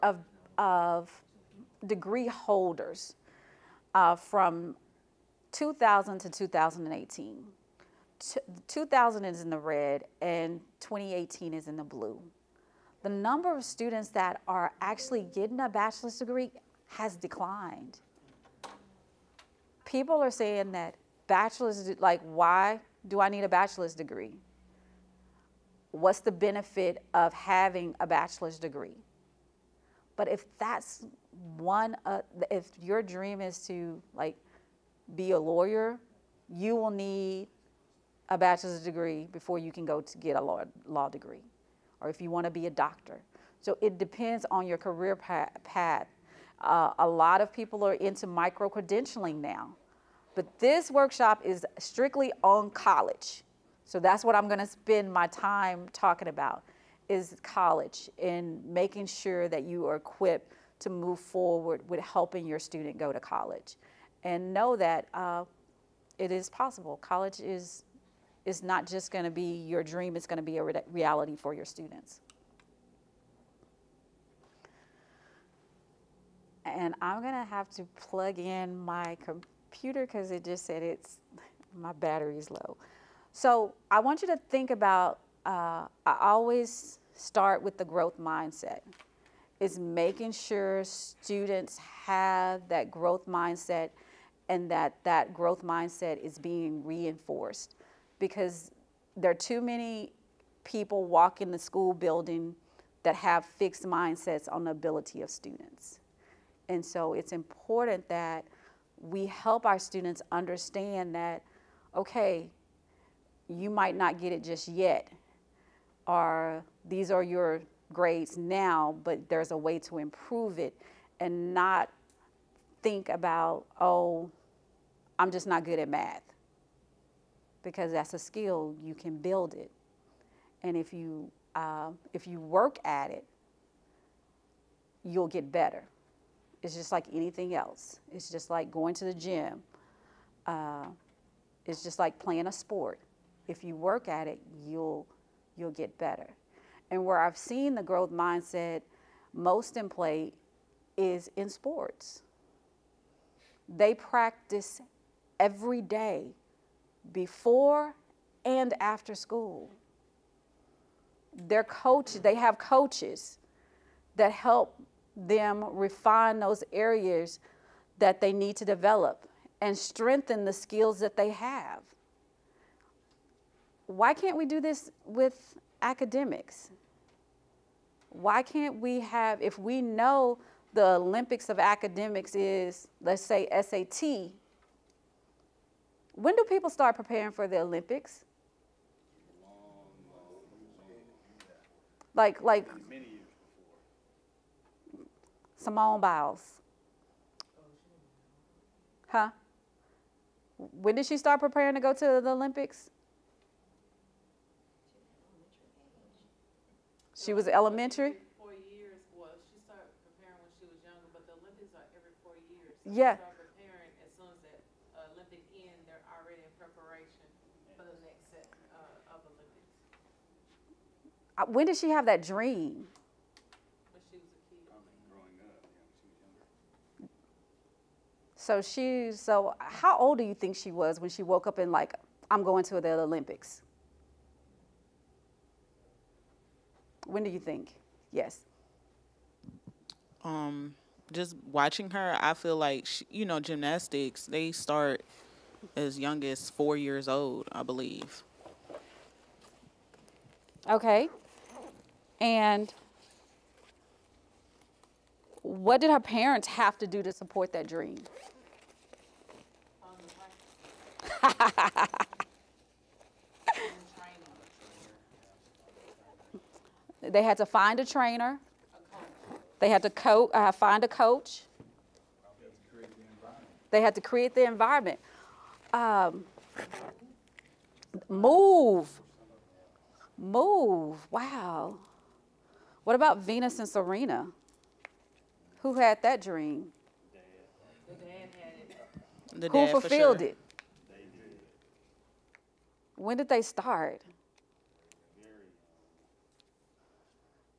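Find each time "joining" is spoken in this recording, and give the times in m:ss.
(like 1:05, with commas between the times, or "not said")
not said.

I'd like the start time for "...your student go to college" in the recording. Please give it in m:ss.
1:02.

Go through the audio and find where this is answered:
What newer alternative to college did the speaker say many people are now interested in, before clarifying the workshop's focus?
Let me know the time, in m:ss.
0:48.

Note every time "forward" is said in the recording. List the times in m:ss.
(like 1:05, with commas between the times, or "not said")
1:01.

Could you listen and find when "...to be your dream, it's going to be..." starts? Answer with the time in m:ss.
1:09.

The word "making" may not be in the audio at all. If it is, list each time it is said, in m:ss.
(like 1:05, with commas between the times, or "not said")
0:58, 1:29.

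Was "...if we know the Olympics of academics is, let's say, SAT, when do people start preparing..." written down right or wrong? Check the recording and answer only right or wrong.
right.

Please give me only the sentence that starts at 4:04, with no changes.
They start as young as four years old, I believe.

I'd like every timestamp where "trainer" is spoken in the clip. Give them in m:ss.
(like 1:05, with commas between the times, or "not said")
4:27.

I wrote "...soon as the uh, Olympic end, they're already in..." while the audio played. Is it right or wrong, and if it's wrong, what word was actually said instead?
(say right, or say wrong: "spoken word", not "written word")
right.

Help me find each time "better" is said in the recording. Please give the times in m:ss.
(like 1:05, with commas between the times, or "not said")
2:15, 2:25.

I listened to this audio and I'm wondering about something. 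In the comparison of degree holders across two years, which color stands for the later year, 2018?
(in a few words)
blue.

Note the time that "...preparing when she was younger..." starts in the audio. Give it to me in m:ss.
3:30.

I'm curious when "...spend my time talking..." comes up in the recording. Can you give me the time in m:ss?
0:54.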